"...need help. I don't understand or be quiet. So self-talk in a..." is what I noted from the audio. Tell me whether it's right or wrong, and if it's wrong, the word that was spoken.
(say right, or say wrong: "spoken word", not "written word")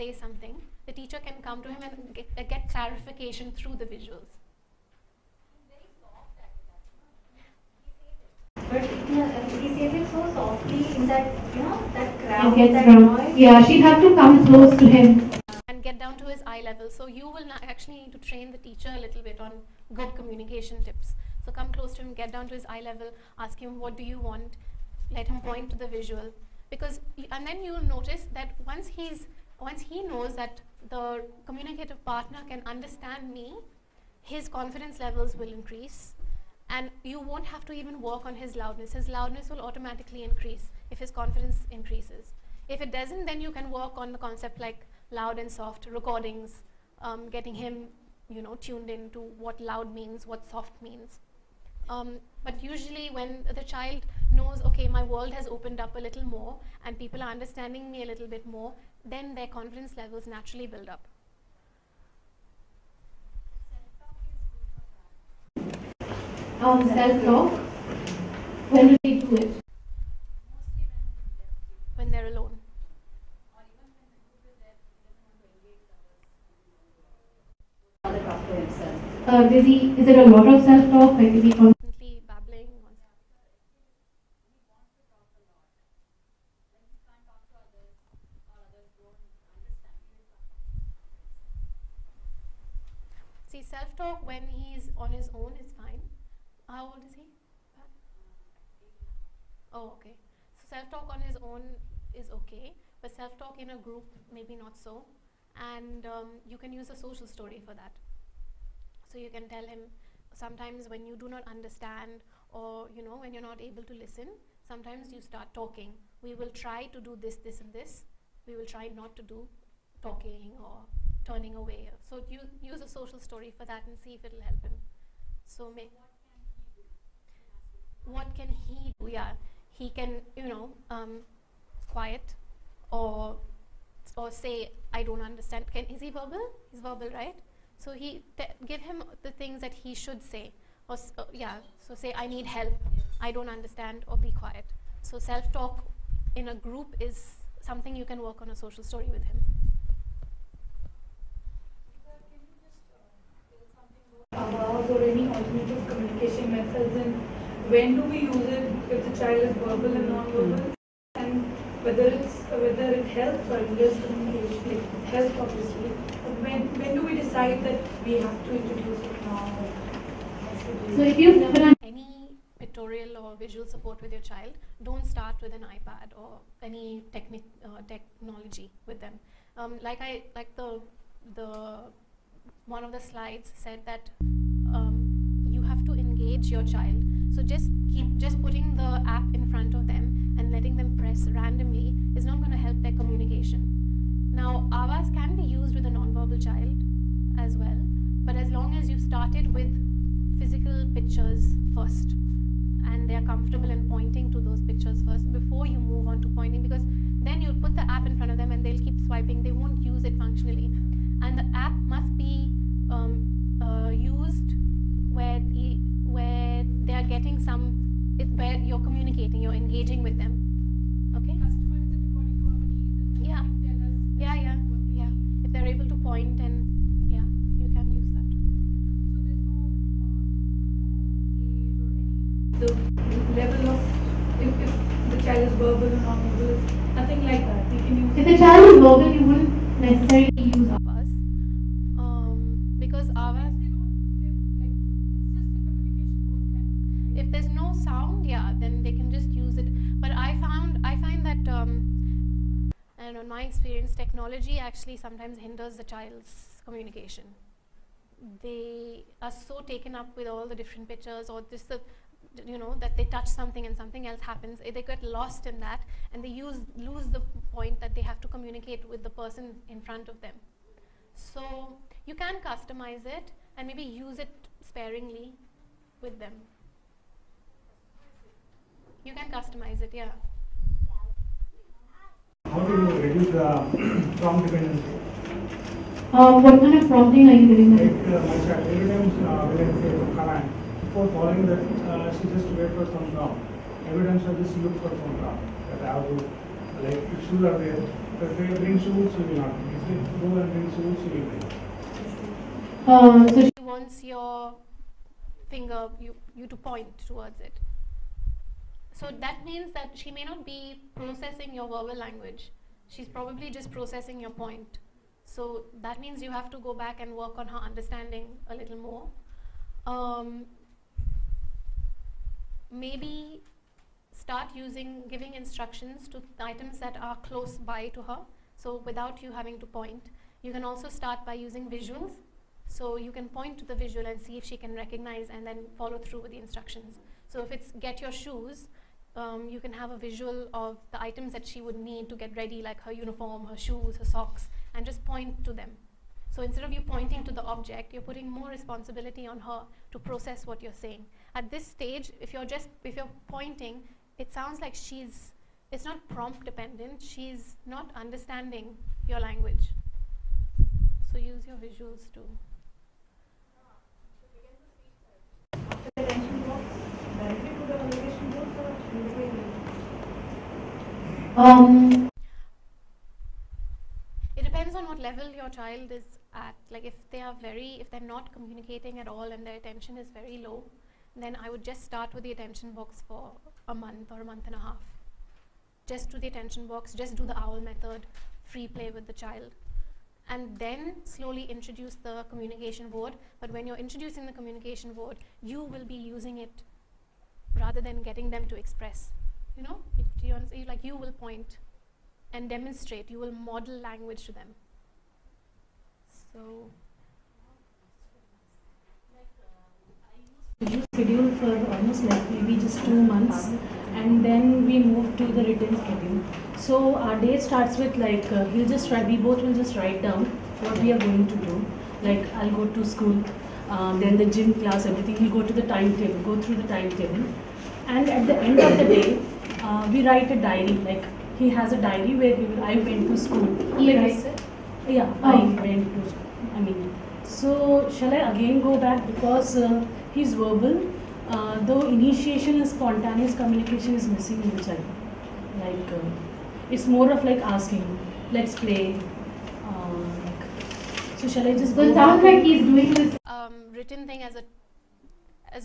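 right.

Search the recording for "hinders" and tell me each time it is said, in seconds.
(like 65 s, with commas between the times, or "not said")
163 s, 255 s.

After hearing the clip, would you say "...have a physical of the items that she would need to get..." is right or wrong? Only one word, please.
wrong.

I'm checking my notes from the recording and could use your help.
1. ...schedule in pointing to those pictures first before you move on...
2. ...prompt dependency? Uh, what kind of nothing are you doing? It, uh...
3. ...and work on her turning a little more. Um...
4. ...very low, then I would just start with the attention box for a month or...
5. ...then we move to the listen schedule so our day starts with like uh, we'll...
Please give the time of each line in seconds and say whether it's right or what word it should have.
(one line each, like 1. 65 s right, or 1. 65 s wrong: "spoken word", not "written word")
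1. 203 s wrong: "comfortable", not "schedule"
2. 284 s wrong: "prompting", not "nothing"
3. 317 s wrong: "understanding", not "turning"
4. 380 s right
5. 414 s wrong: "written", not "listen".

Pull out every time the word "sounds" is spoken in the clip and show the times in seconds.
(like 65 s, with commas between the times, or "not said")
247 s, 354 s, 451 s.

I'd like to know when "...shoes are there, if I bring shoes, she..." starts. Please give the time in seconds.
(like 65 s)
297 s.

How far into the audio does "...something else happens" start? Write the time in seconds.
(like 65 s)
263 s.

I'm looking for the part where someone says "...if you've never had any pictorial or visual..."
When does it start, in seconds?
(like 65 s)
171 s.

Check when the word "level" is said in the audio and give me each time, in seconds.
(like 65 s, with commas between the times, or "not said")
16 s, 22 s, 34 s, 59 s, 233 s, 374 s.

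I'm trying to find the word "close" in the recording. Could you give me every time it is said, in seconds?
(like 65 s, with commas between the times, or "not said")
14 s, 21 s, 327 s.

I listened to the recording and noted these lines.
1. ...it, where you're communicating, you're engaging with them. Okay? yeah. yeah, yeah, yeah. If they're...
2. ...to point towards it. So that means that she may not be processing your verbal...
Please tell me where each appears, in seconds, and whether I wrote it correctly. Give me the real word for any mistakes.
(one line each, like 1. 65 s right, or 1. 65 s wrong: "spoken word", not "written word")
1. 218 s right
2. 306 s right.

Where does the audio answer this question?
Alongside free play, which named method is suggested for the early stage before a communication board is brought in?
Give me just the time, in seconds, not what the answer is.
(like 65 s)
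387 s.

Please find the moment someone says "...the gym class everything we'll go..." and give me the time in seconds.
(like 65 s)
424 s.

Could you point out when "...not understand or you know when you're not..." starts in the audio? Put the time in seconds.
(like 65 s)
111 s.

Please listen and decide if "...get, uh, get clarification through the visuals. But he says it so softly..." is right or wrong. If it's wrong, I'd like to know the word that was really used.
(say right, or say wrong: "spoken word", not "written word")
right.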